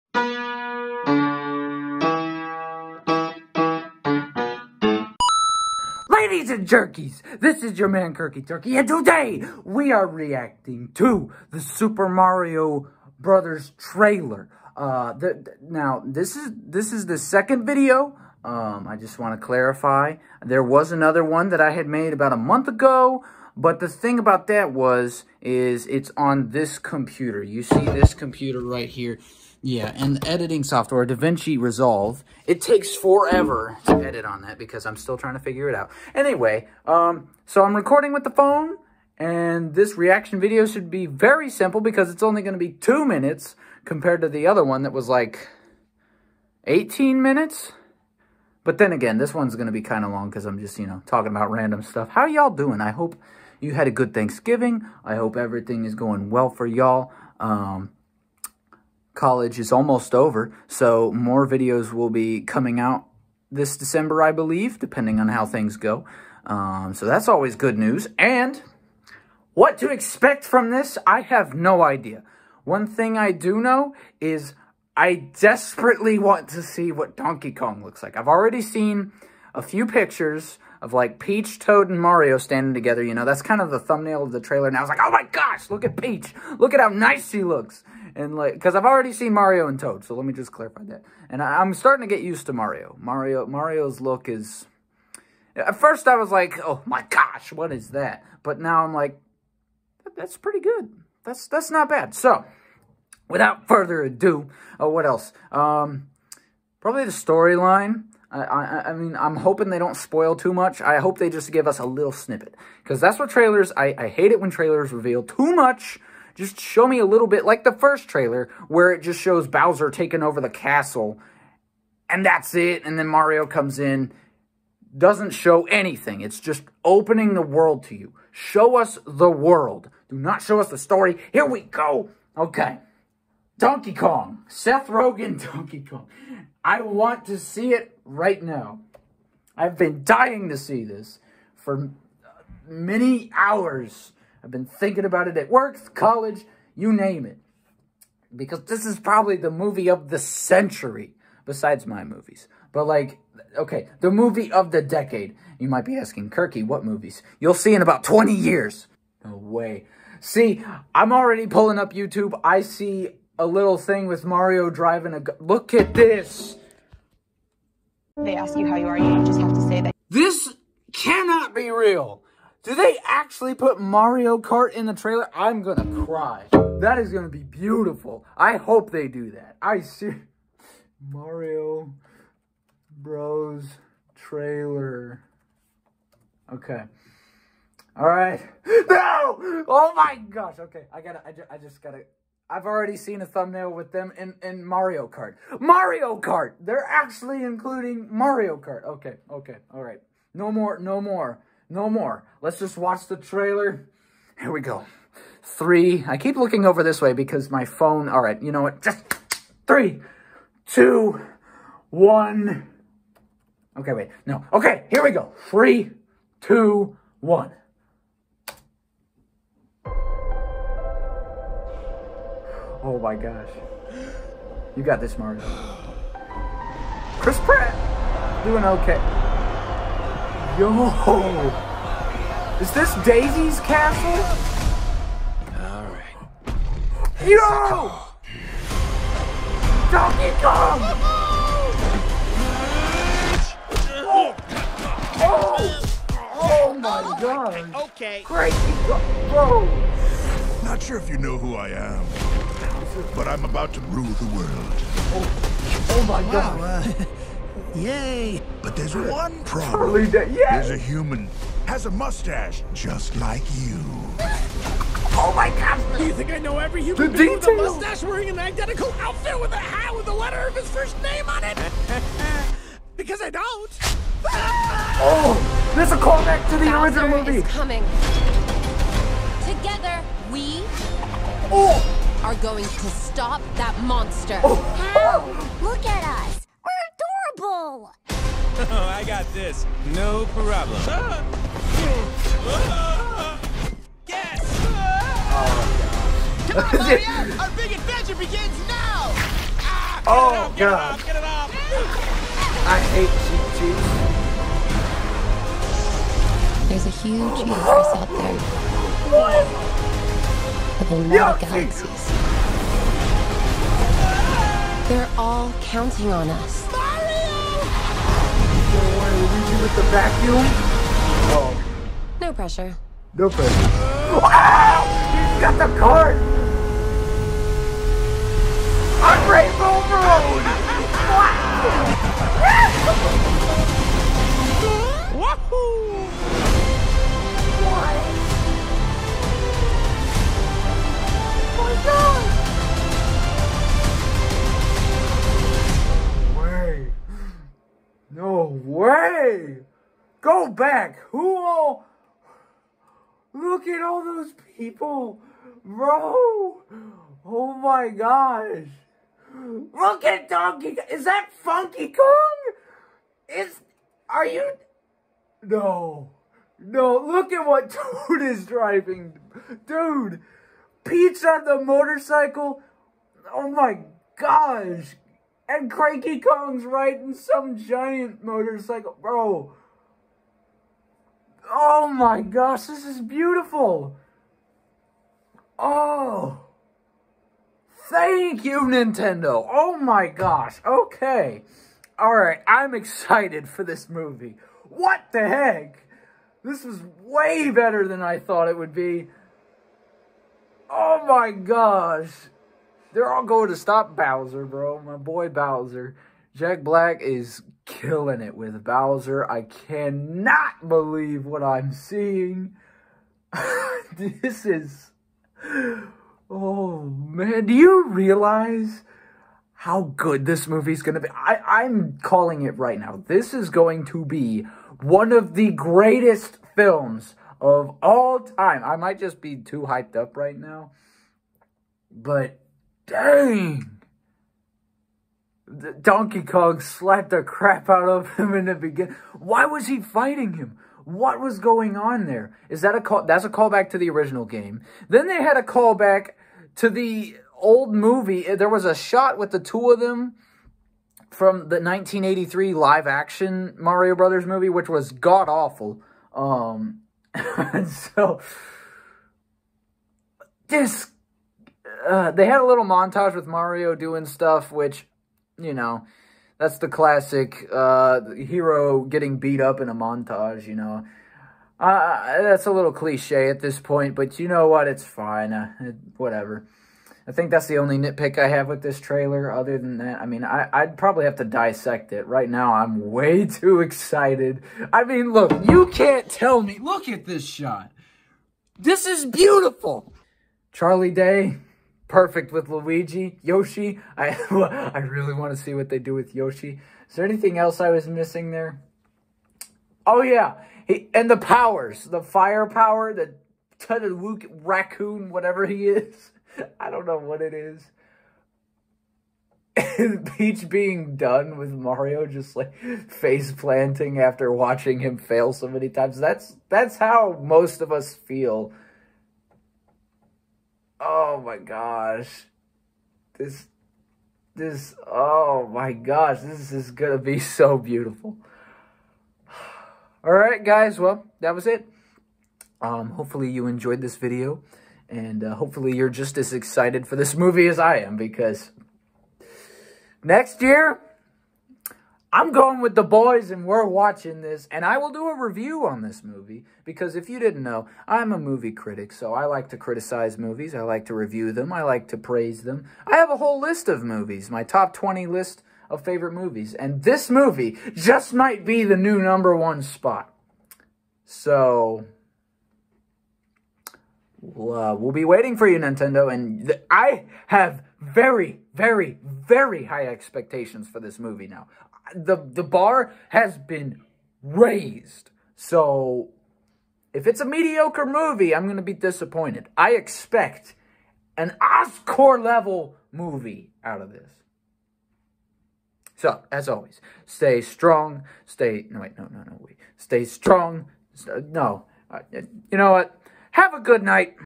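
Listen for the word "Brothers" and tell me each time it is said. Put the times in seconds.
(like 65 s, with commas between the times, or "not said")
13 s, 453 s.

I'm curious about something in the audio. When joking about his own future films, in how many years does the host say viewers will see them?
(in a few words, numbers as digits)
20 years.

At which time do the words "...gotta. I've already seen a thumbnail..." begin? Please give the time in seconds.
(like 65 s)
191 s.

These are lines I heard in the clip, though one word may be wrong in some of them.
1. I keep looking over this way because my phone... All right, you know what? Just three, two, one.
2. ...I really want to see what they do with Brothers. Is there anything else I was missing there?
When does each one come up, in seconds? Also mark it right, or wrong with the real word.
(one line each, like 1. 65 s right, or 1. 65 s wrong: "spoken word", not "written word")
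1. 206 s right
2. 494 s wrong: "Yoshi", not "Brothers".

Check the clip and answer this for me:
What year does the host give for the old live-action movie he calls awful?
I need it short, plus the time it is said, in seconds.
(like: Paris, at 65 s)
1983, at 451 s.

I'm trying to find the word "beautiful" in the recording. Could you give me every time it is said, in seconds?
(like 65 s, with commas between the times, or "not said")
177 s, 383 s, 489 s, 527 s.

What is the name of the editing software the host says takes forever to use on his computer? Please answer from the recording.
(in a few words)
DaVinci Resolve.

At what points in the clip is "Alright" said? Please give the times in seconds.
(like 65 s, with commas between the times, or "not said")
235 s, 391 s.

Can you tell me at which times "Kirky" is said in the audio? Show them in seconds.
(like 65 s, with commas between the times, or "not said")
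8 s, 156 s.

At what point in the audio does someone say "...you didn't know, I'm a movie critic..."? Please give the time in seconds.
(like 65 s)
547 s.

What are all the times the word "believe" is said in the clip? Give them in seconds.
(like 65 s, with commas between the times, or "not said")
64 s, 410 s.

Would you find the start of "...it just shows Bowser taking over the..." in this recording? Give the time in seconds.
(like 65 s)
118 s.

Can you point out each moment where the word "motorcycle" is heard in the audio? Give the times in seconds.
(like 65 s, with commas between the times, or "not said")
371 s, 378 s.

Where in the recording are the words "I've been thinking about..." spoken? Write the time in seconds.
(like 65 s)
144 s.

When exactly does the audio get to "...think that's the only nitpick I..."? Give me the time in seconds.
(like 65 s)
477 s.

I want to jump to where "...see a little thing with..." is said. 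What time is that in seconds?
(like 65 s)
162 s.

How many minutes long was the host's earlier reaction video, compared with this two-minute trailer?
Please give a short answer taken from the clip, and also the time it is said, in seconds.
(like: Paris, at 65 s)
18 minutes, at 46 s.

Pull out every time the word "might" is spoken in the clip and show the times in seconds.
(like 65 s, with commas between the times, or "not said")
155 s, 428 s, 558 s.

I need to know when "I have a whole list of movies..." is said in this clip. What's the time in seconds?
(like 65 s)
552 s.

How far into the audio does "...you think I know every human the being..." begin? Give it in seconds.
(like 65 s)
266 s.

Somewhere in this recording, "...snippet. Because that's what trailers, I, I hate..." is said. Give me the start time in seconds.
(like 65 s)
112 s.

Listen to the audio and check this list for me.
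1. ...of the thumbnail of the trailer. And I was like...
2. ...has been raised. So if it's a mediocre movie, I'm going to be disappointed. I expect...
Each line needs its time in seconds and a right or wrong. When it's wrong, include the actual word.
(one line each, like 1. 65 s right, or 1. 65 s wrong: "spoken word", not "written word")
1. 83 s right
2. 573 s right.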